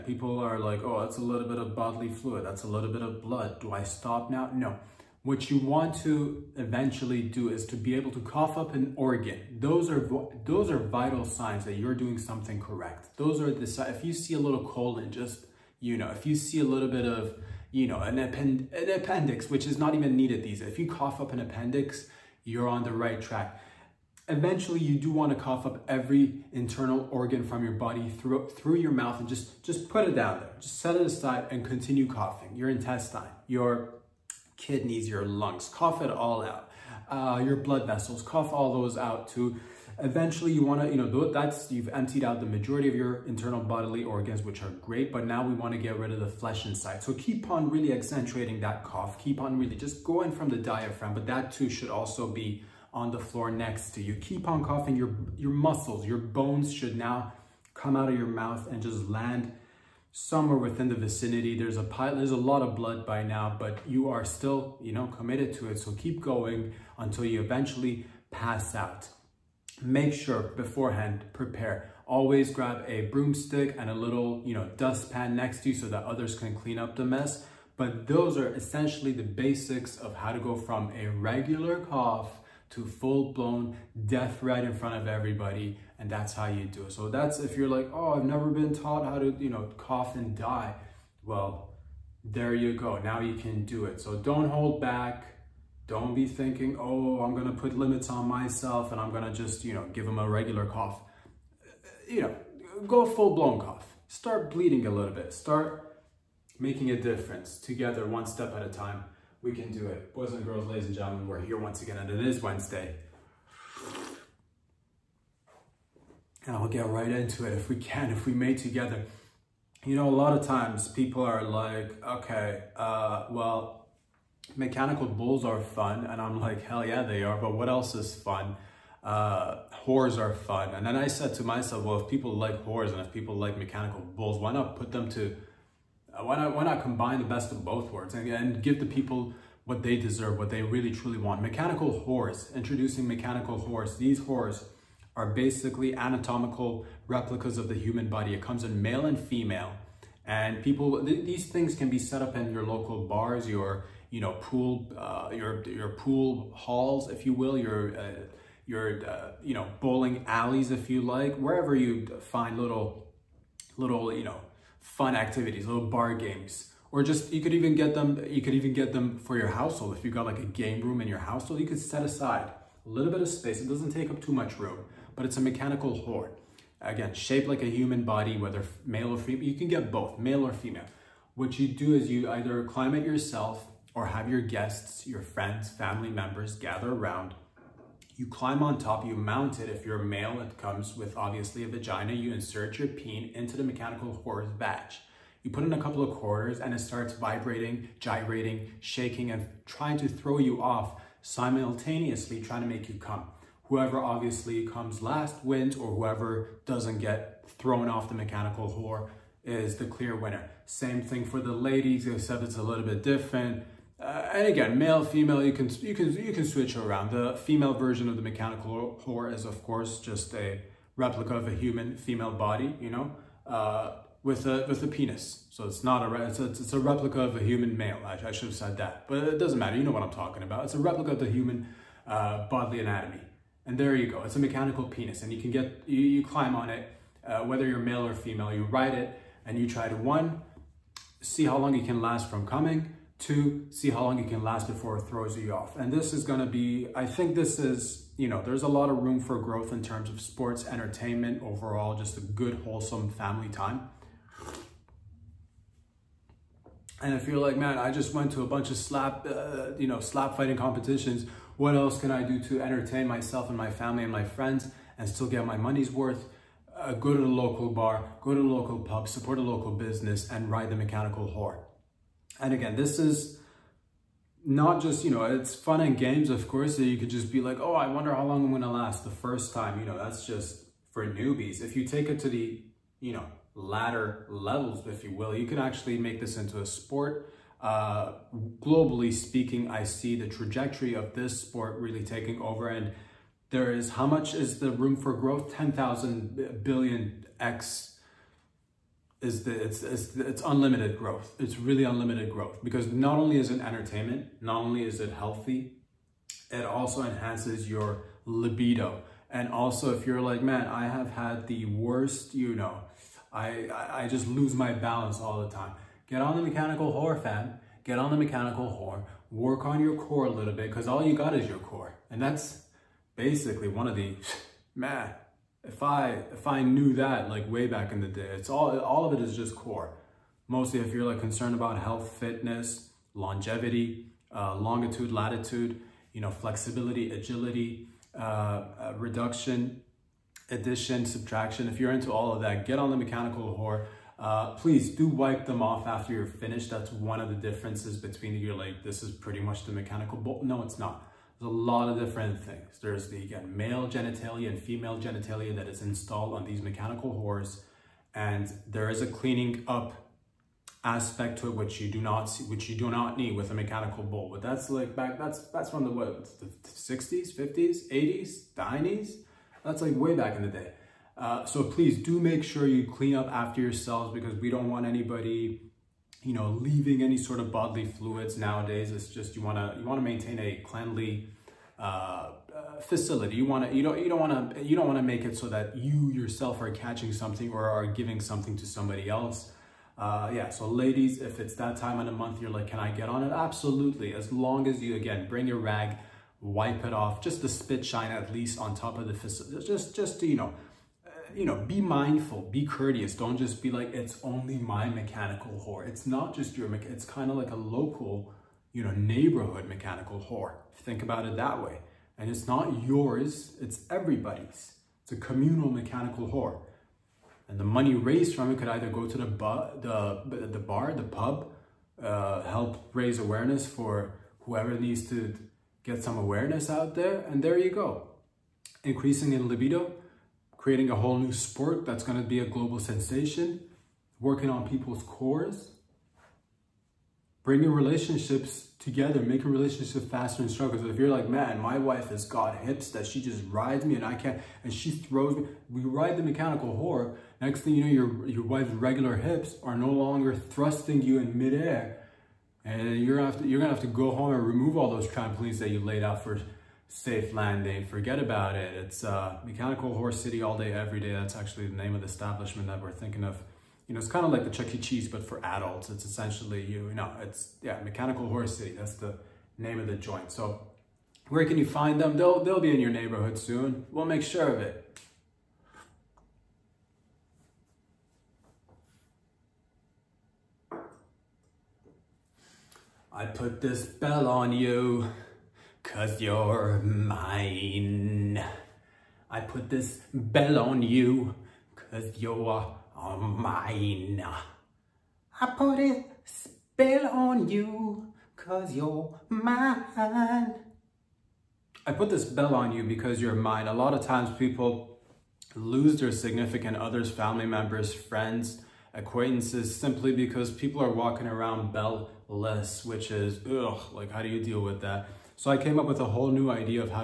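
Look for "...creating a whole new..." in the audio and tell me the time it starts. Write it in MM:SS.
07:10.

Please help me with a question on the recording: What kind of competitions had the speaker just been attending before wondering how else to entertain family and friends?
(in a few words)
slap fighting competitions.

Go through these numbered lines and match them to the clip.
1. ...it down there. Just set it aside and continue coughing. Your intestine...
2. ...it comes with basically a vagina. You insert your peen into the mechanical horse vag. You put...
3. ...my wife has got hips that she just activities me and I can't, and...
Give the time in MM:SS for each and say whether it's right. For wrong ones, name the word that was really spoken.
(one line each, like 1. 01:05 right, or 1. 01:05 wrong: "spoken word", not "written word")
1. 00:30 right
2. 03:10 wrong: "obviously", not "basically"
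3. 07:21 wrong: "rides", not "activities".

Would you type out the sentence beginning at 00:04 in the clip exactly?
No what you want to eventually do is to be able to cough up an organ.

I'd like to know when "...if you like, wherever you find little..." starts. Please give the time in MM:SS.
02:40.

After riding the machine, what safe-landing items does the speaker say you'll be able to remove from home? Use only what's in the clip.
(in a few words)
trampolines.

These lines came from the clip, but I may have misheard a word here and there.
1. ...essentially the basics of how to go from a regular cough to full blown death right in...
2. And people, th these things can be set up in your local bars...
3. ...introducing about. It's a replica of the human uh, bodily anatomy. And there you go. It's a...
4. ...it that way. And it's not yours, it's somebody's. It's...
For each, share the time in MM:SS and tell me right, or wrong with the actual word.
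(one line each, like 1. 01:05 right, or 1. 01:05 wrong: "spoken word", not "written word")
1. 01:18 right
2. 02:30 right
3. 03:50 wrong: "talking", not "introducing"
4. 06:51 wrong: "everybody", not "somebody".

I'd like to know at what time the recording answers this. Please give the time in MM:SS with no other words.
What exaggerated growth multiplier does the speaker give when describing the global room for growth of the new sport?
04:55.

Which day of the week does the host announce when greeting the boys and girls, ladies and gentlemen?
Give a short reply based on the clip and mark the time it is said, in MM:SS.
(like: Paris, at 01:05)
Wednesday, at 01:52.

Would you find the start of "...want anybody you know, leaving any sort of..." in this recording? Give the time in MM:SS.
06:14.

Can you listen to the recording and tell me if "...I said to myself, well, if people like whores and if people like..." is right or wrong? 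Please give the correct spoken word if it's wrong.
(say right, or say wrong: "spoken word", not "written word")
right.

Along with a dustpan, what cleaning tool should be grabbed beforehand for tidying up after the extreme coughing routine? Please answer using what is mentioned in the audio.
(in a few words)
broomstick.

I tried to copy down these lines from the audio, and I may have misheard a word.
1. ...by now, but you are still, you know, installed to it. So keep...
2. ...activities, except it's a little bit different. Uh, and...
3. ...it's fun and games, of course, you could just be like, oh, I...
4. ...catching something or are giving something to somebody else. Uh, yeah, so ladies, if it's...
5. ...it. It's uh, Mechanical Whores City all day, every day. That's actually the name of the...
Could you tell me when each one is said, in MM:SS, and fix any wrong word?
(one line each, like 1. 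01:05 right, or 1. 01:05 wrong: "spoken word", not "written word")
1. 01:03 wrong: "committed", not "installed"
2. 03:31 wrong: "ladies", not "activities"
3. 04:35 right
4. 06:26 right
5. 07:38 right.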